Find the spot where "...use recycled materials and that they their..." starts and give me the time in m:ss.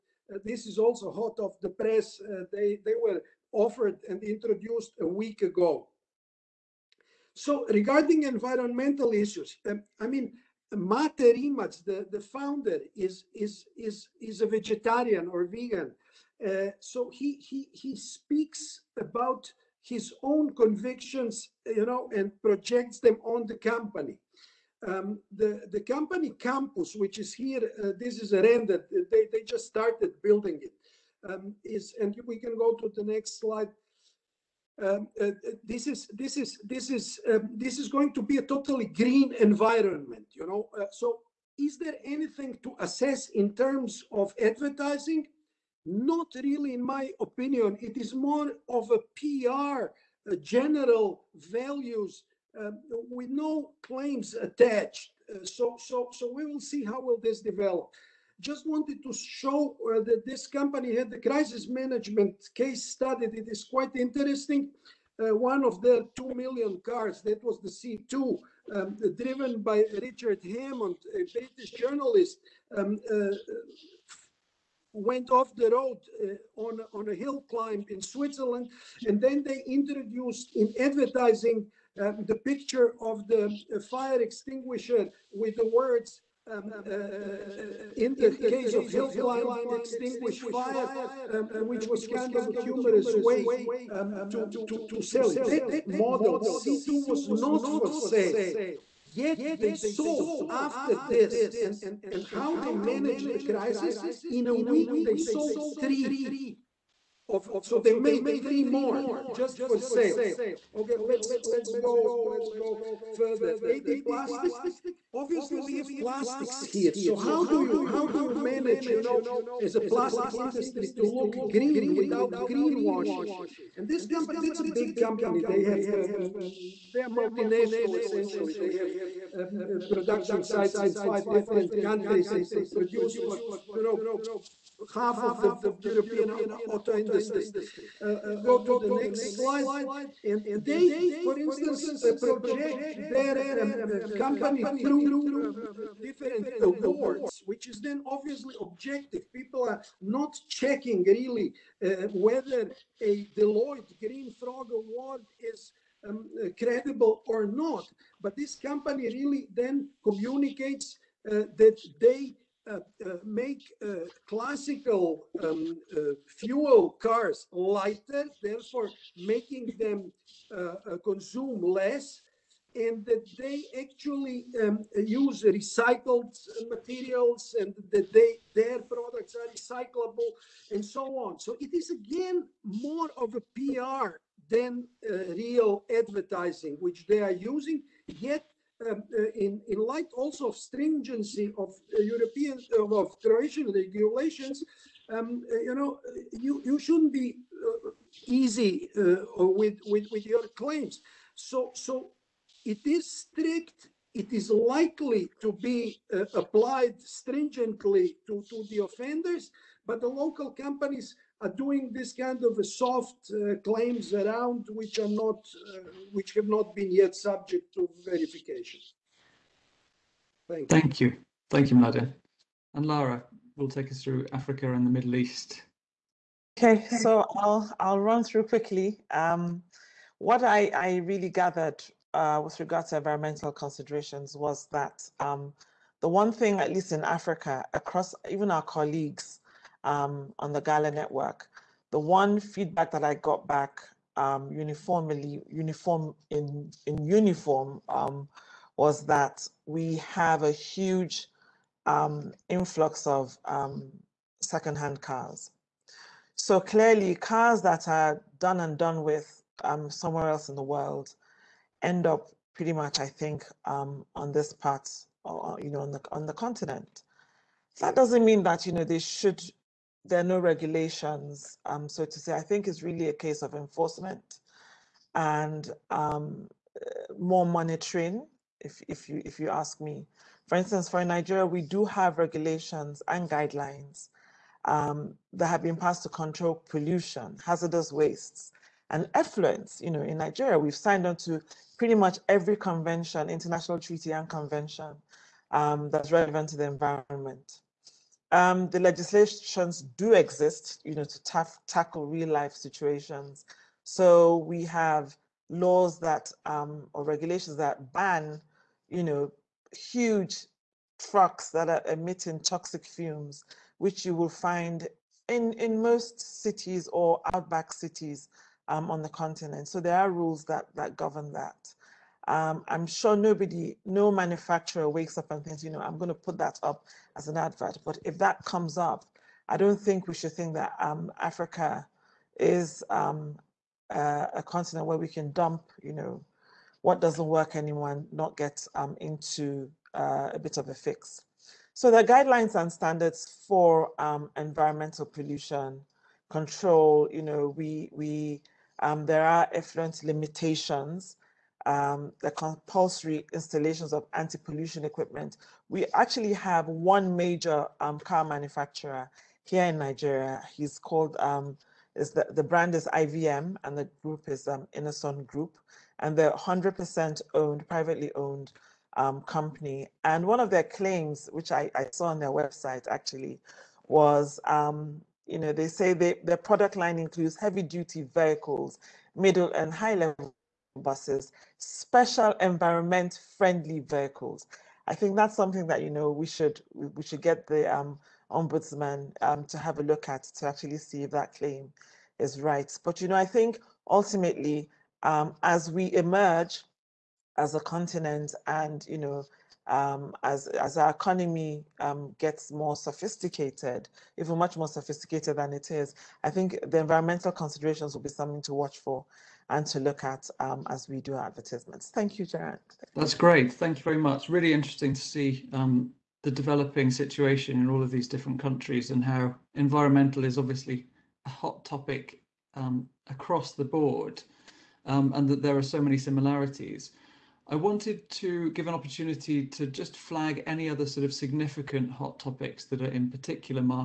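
2:54.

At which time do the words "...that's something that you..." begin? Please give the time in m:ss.
6:25.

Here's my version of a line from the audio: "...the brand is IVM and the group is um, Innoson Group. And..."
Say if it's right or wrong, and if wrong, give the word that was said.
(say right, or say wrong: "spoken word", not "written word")
right.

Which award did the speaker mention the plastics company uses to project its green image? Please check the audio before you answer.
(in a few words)
Deloitte Green Frog Award.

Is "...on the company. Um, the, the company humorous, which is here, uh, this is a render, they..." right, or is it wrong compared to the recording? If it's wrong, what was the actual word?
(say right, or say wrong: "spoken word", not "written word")
wrong: "campus", not "humorous".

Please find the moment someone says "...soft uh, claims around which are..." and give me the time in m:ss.
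3:32.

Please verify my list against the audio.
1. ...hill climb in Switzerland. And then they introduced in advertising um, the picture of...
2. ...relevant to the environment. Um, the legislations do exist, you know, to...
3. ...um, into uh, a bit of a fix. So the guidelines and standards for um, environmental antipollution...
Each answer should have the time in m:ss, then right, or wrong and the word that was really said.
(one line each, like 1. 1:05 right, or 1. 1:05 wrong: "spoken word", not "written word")
1. 1:17 right
2. 4:56 right
3. 5:38 wrong: "pollution", not "antipollution".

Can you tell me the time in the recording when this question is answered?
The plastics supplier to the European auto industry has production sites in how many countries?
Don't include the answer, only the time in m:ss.
2:10.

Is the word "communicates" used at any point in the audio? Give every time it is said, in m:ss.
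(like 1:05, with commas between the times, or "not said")
2:40.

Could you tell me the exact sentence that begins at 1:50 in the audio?
Okay, let's let's go let's go further.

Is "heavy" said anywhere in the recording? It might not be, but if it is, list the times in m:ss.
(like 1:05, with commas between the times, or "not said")
6:17.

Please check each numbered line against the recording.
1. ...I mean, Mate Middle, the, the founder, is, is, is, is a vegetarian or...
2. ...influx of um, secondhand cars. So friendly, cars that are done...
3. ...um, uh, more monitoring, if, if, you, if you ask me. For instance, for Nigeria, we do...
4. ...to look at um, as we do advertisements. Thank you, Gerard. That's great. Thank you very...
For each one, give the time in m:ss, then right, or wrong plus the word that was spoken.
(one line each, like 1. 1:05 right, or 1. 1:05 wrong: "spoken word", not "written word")
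1. 0:09 wrong: "Rimac", not "Middle"
2. 4:12 wrong: "clearly", not "friendly"
3. 4:35 right
4. 6:49 right.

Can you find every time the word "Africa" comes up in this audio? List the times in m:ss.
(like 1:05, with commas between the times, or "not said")
3:44, 3:57, 5:31.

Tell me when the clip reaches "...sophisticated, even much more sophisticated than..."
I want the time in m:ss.
6:42.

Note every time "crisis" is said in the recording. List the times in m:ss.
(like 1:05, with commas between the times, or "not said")
1:01, 1:43.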